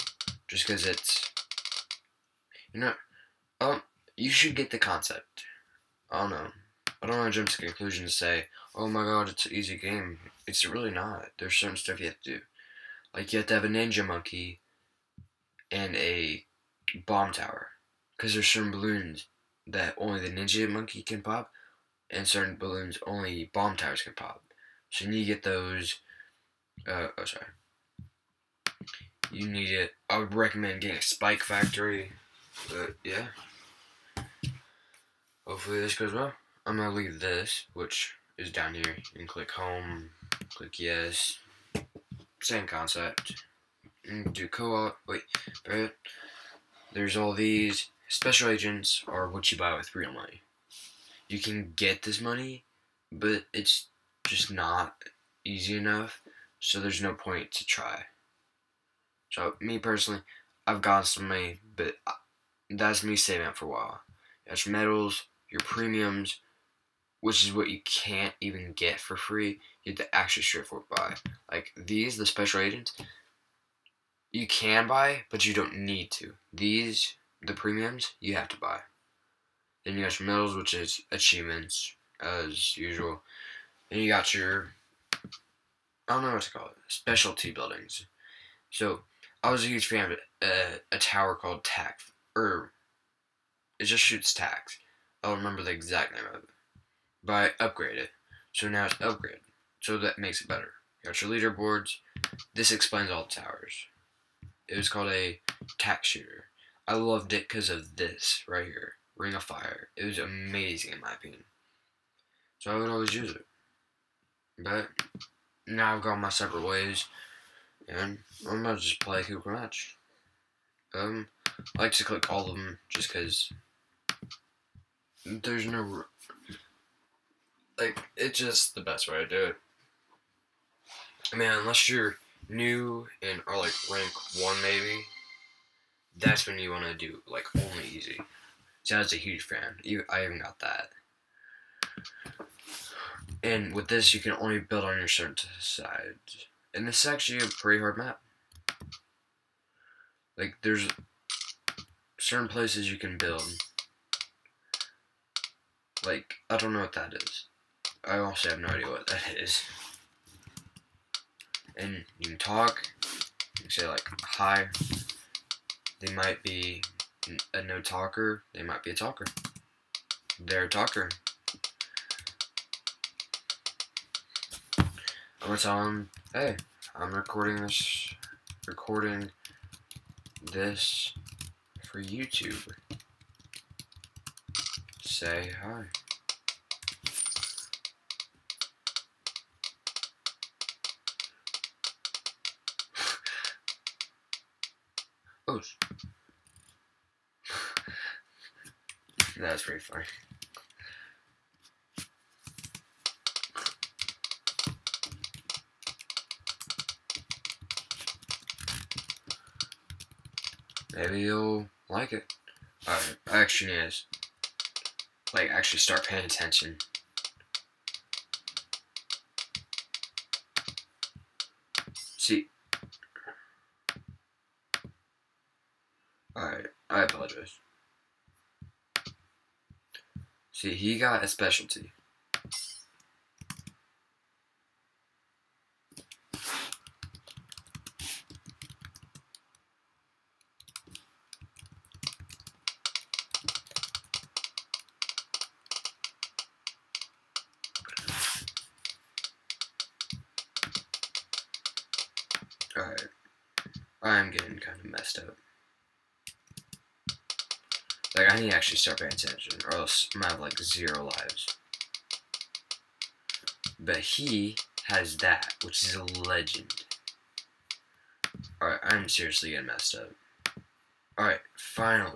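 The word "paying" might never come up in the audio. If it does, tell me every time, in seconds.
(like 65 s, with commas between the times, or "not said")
216 s, 258 s.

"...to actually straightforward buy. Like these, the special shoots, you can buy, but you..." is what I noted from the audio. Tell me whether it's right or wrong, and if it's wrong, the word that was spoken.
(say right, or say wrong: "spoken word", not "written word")
wrong: "agents", not "shoots".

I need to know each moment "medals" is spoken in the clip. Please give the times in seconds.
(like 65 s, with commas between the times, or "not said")
64 s, 80 s.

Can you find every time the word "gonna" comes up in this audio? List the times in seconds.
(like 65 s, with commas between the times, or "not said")
118 s, 260 s.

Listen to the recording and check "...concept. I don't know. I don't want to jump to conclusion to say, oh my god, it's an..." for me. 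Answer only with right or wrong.
right.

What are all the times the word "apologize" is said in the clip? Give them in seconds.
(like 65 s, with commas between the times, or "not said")
227 s.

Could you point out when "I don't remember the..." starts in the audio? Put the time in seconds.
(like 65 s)
95 s.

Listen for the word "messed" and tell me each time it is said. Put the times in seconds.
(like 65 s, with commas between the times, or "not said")
254 s, 269 s.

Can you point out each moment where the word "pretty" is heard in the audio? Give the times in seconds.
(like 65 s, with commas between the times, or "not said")
147 s, 199 s.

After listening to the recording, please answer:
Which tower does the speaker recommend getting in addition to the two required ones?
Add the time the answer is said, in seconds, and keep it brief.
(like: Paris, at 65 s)
Spike Factory, at 31 s.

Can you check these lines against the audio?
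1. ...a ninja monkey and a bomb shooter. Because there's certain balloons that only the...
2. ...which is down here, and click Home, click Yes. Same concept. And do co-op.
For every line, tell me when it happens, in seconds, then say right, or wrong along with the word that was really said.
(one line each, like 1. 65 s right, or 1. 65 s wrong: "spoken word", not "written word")
1. 13 s wrong: "tower", not "shooter"
2. 37 s right.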